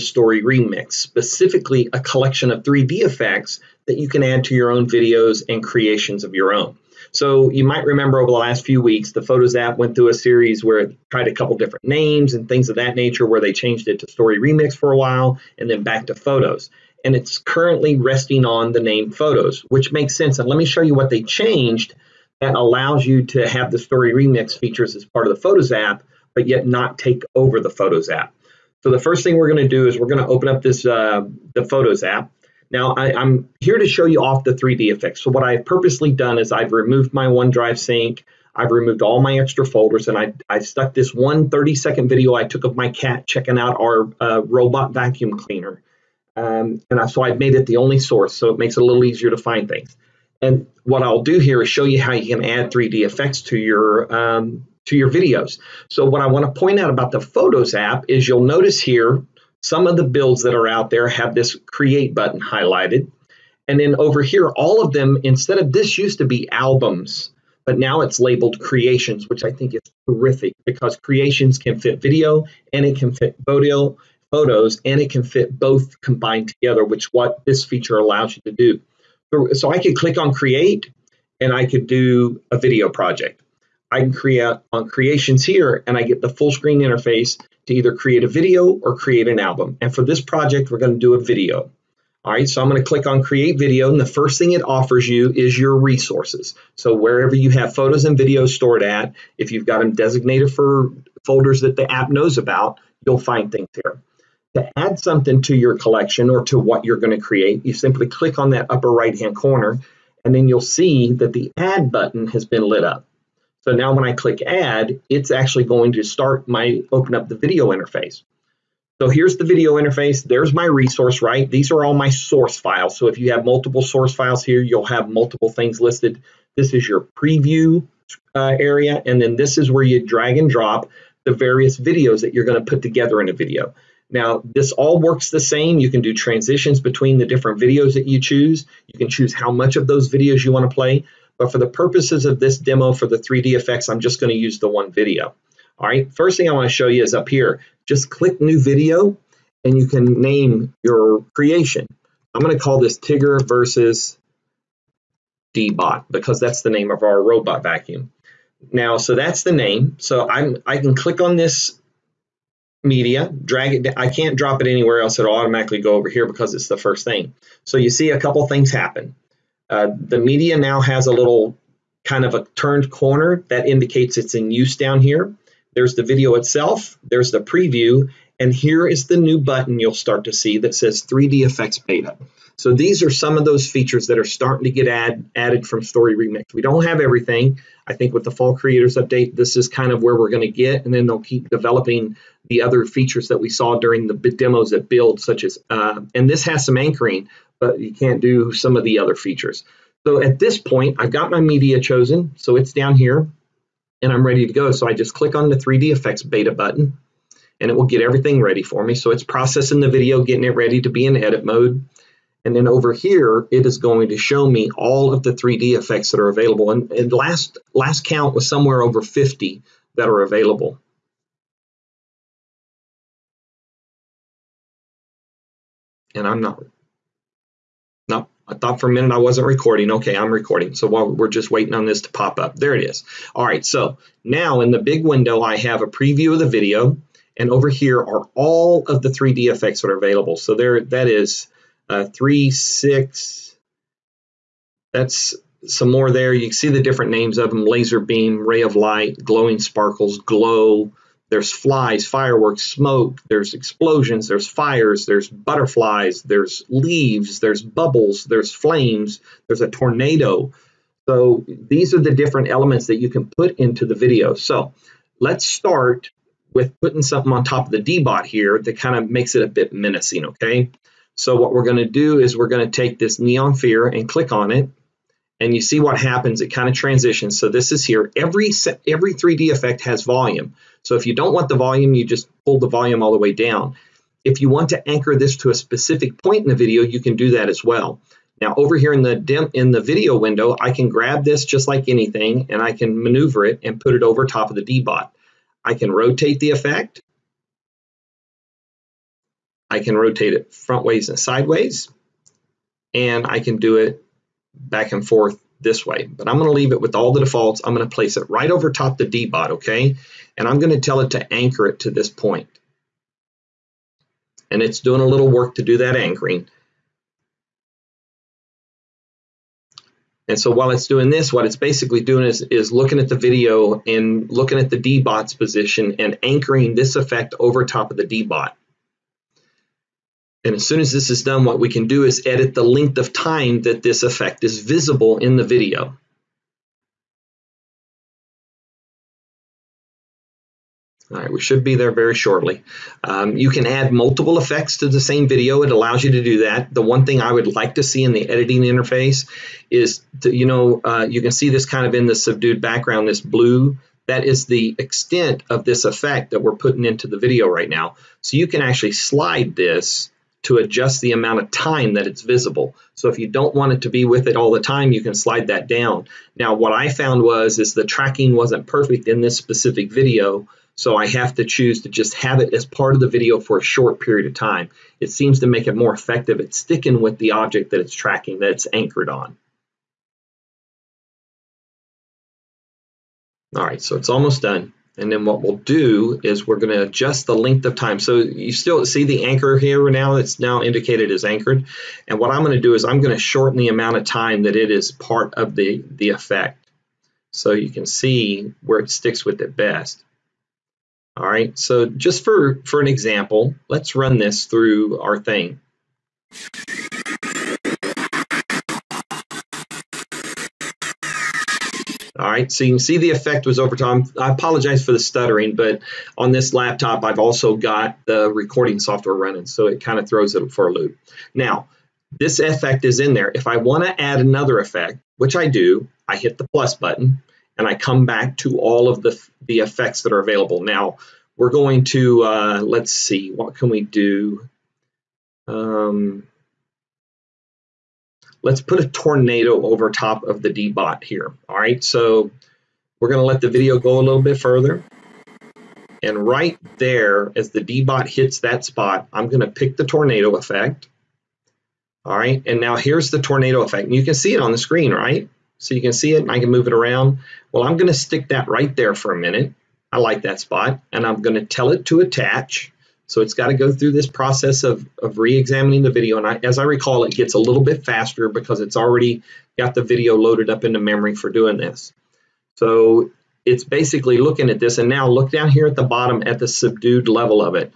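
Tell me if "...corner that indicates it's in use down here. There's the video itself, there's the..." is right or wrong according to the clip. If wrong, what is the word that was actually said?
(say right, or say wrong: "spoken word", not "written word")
right.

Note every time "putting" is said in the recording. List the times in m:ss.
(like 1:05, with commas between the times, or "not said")
4:26, 5:56.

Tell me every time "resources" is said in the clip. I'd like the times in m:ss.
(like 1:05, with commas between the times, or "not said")
1:35, 2:00.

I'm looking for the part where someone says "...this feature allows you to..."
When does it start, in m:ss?
1:17.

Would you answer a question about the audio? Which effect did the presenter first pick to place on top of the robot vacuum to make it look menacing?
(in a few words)
neon sphere.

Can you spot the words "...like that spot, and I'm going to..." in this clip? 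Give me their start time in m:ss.
7:39.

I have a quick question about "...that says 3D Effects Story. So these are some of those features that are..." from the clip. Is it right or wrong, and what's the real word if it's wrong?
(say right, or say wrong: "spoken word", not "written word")
wrong: "Beta", not "Story".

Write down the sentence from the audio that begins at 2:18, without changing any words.
You can choose how much of those videos you want to play.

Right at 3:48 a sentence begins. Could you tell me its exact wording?
No, I thought for a minute I wasn't recording.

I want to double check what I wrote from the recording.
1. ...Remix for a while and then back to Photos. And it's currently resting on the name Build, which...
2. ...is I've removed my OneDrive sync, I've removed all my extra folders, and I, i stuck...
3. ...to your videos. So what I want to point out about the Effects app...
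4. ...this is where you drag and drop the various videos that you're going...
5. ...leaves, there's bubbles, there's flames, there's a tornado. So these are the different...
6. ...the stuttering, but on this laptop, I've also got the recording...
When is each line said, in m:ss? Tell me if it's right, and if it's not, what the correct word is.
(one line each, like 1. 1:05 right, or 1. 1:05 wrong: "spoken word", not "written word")
1. 0:14 wrong: "Photos", not "Build"
2. 0:36 right
3. 0:54 wrong: "Photos", not "Effects"
4. 2:09 right
5. 4:16 right
6. 6:54 right.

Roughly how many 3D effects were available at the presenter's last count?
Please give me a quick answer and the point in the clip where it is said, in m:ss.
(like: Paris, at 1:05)
over 50, at 3:38.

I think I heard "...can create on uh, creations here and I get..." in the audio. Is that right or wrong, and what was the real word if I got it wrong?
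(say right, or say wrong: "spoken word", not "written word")
right.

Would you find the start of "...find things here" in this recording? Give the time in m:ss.
1:43.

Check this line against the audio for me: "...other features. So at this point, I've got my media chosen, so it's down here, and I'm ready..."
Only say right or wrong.
right.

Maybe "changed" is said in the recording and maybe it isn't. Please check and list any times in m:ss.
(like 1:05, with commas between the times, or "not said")
0:13, 0:21.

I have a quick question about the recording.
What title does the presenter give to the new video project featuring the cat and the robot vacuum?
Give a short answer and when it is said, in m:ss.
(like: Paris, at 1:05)
Tigger versus Dbot, at 2:32.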